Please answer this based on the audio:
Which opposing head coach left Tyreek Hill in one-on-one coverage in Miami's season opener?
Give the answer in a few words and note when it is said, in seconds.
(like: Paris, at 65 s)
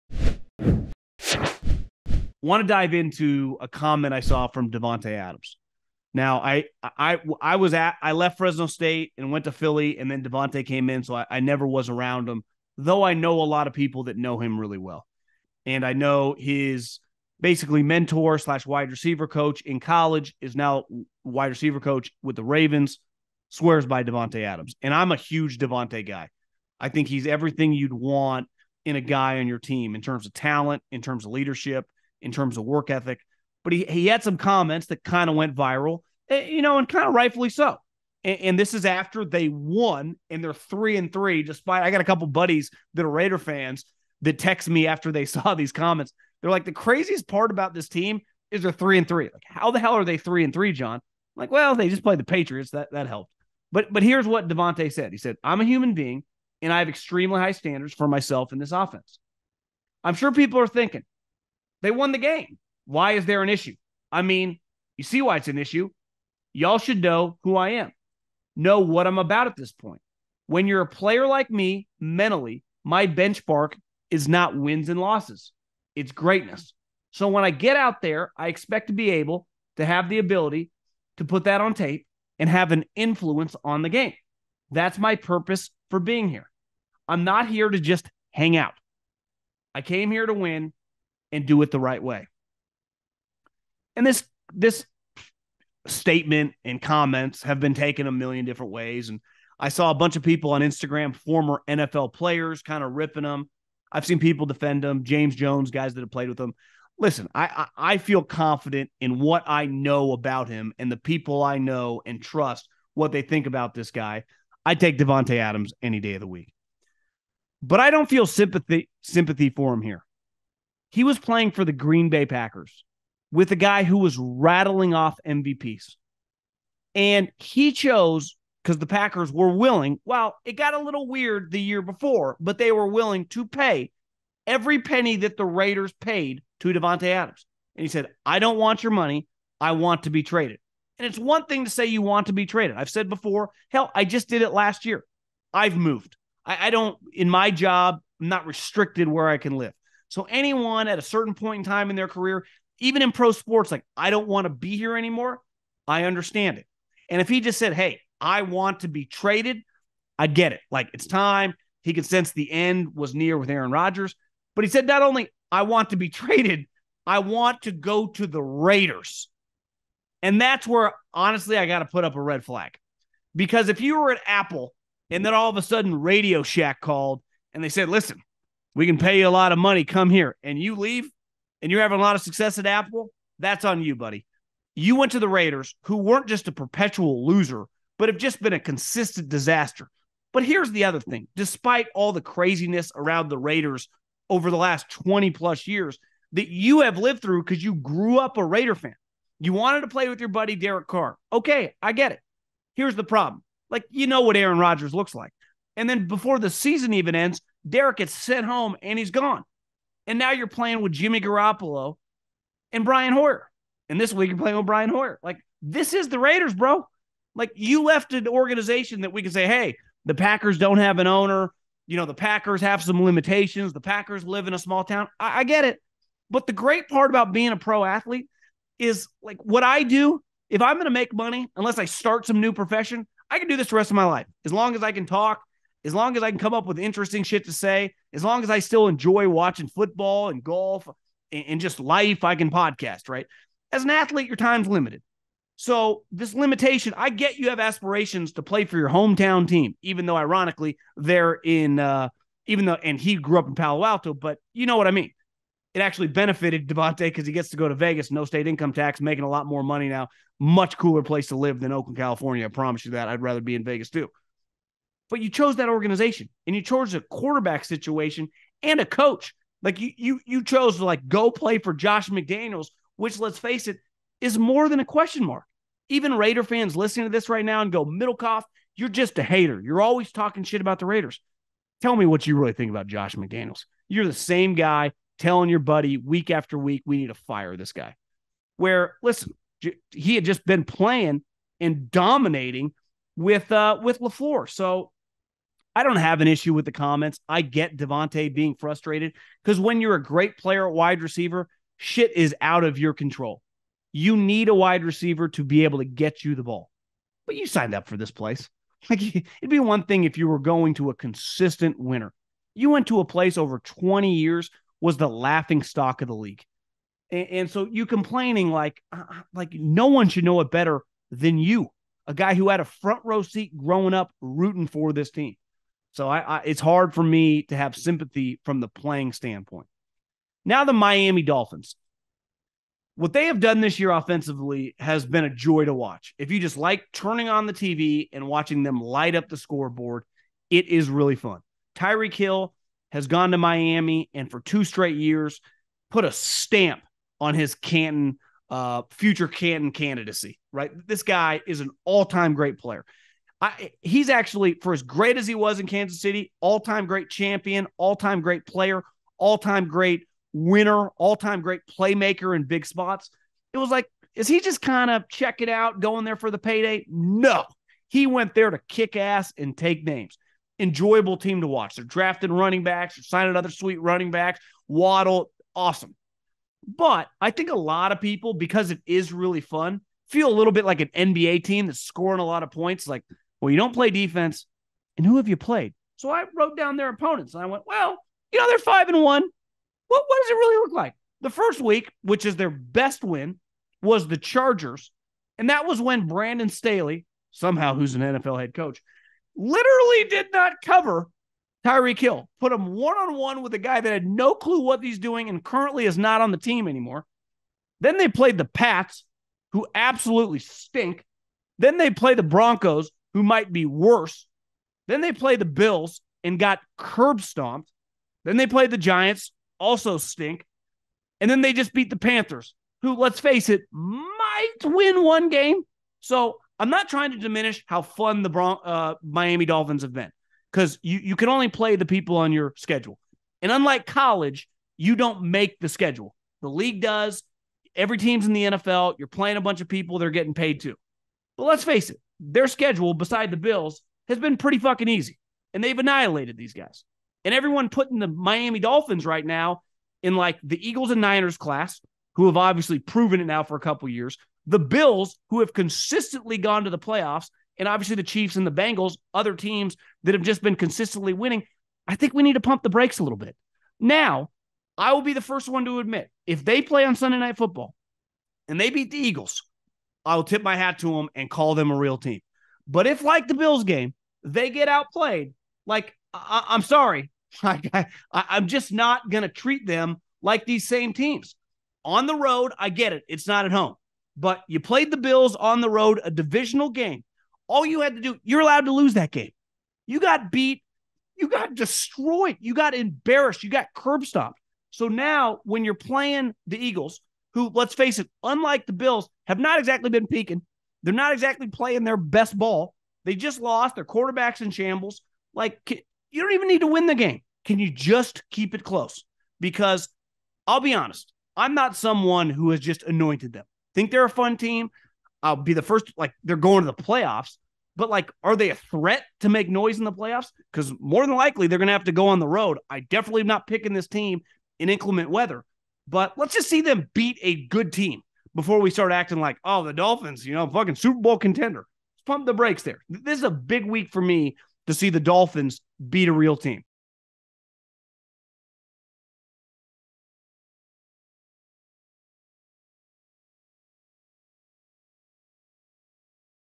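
Brandon Staley, at 396 s.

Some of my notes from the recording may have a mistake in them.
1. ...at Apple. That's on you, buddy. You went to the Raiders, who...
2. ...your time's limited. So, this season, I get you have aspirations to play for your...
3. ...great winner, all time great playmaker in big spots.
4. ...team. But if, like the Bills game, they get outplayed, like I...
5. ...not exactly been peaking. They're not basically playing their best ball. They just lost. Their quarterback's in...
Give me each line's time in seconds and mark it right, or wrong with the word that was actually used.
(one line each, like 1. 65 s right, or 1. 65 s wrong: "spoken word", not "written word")
1. 182 s right
2. 244 s wrong: "limitation", not "season"
3. 359 s right
4. 471 s right
5. 499 s wrong: "exactly", not "basically".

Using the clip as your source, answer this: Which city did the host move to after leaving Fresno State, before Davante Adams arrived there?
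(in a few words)
Philly.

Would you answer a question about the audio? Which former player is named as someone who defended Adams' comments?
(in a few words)
James Jones.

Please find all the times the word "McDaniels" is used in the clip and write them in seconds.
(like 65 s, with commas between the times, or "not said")
272 s, 283 s.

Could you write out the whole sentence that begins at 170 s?
And that's where honestly I got to put up a red flag.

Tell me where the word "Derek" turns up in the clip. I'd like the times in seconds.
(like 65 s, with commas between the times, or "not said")
200 s, 207 s.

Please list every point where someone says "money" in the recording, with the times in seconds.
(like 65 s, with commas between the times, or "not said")
138 s, 179 s, 231 s, 259 s.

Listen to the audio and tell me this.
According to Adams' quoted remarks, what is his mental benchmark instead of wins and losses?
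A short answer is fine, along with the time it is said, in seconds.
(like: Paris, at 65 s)
Greatness, at 76 s.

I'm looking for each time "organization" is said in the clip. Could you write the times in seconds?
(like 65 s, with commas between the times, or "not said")
218 s, 265 s.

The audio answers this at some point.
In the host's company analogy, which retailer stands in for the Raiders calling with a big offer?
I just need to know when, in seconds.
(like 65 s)
175 s.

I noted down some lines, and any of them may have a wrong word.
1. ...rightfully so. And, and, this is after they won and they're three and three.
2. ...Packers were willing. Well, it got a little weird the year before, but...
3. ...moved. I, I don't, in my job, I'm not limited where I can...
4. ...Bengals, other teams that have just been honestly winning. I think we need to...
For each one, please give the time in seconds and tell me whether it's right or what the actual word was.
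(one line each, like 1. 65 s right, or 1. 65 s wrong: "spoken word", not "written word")
1. 37 s right
2. 128 s right
3. 145 s wrong: "restricted", not "limited"
4. 458 s wrong: "consistently", not "honestly".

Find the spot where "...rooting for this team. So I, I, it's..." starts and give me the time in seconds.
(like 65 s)
324 s.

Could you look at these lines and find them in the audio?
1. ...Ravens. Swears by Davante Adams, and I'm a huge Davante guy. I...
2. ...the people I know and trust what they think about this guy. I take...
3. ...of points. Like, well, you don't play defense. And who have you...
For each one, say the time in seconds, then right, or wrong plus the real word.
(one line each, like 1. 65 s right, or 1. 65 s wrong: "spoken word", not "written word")
1. 22 s right
2. 110 s right
3. 382 s right.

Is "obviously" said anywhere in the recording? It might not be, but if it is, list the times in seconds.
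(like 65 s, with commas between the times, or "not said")
452 s, 457 s.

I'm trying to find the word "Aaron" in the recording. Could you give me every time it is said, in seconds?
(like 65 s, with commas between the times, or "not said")
163 s, 204 s.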